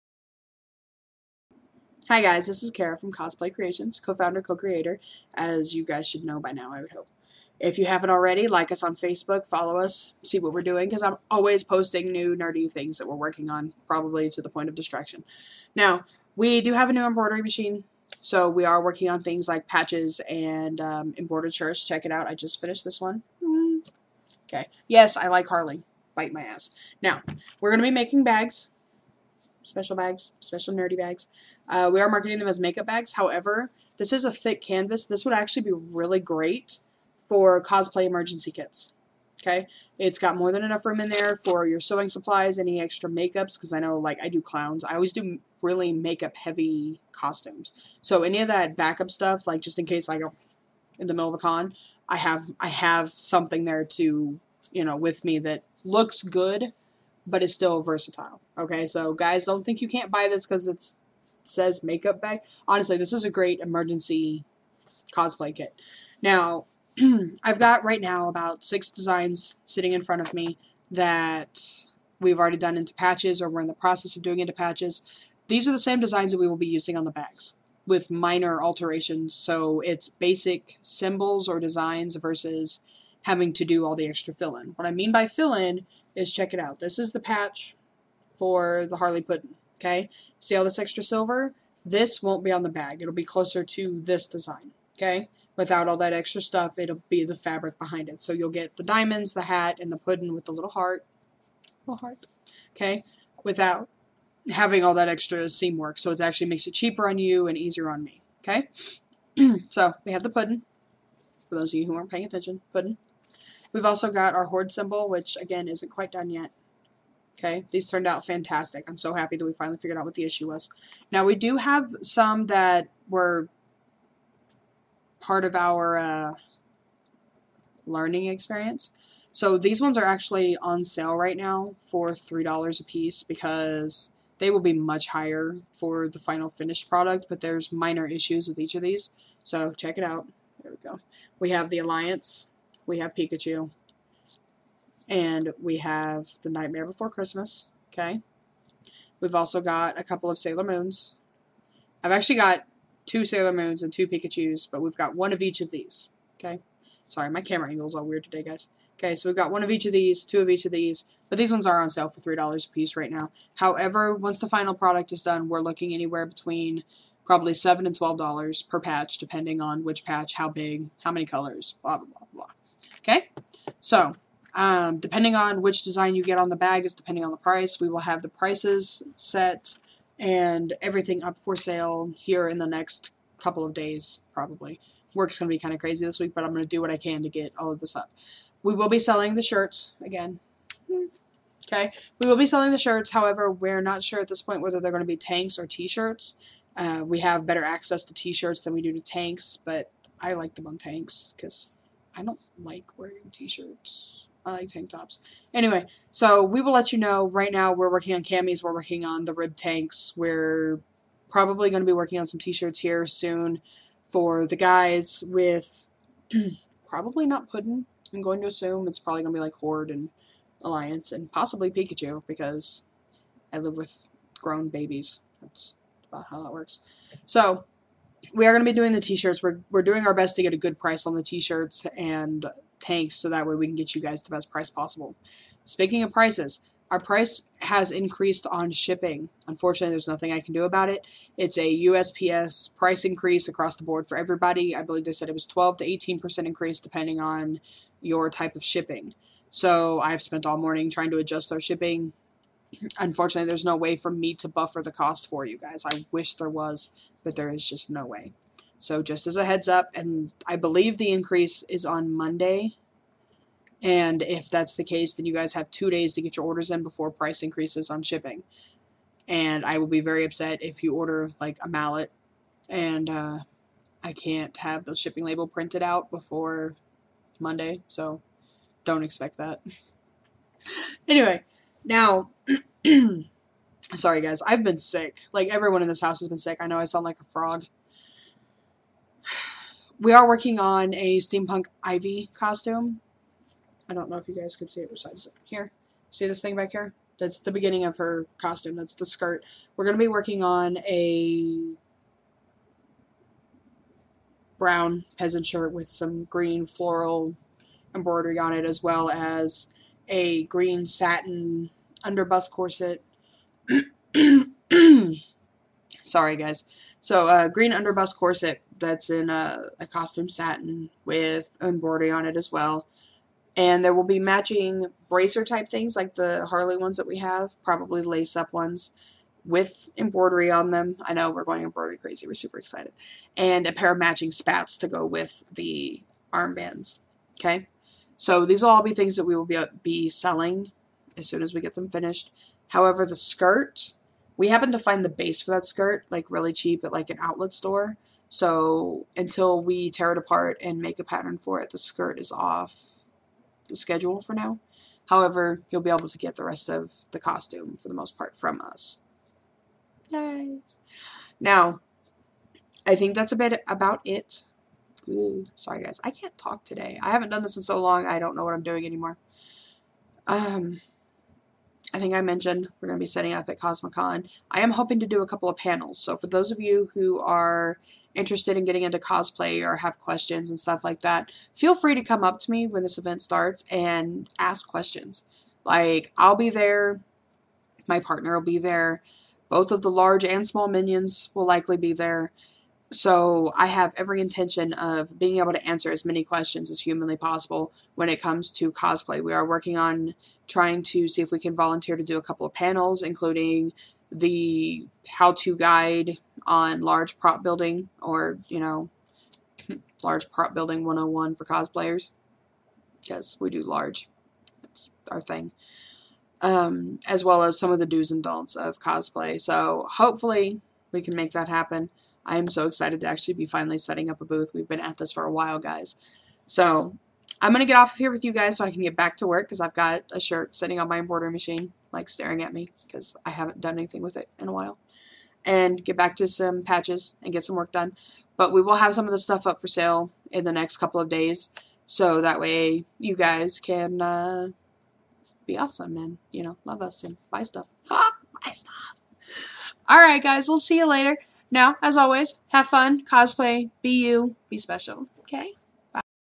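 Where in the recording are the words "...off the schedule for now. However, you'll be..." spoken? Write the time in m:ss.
5:52.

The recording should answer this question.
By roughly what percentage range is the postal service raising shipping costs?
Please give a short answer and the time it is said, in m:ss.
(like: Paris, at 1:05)
12 to 18%, at 4:05.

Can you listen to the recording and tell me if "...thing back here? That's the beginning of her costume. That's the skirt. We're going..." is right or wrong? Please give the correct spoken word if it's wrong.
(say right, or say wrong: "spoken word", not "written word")
right.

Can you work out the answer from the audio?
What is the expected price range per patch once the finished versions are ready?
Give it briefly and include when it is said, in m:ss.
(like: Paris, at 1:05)
$7 to $12, at 2:47.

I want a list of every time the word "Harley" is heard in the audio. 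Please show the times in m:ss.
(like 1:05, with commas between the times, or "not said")
0:25, 1:28, 5:26.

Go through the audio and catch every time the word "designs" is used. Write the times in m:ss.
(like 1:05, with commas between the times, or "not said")
1:08, 1:15, 1:21, 1:34, 2:55.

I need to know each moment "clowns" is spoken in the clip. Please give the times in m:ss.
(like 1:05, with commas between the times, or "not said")
0:44.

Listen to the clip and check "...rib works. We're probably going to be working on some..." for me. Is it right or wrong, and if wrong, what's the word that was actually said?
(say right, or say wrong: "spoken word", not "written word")
wrong: "tanks", not "works".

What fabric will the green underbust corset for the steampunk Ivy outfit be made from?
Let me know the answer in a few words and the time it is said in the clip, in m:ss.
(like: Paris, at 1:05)
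costume satin, at 5:19.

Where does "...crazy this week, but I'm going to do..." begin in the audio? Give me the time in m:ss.
3:05.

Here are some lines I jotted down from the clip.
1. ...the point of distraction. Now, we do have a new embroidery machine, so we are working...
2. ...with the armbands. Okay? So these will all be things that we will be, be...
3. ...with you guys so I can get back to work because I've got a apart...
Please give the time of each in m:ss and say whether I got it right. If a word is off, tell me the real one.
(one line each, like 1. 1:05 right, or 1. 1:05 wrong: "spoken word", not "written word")
1. 0:14 right
2. 5:35 right
3. 7:08 wrong: "shirt", not "apart".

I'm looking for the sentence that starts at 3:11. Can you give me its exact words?
Okay, we will be selling the shirts.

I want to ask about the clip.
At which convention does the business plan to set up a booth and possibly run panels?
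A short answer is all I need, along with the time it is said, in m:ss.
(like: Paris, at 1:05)
Cosmicon, at 6:13.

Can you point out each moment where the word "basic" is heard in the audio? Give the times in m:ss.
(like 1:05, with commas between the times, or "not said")
1:20.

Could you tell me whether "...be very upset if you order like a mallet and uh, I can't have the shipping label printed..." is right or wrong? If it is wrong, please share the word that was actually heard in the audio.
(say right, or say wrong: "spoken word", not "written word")
right.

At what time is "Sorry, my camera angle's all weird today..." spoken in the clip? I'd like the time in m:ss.
2:37.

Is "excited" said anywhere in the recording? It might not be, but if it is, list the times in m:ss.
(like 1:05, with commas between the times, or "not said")
5:32, 7:02.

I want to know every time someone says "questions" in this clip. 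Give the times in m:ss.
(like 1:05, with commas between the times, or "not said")
6:19, 6:24, 6:36.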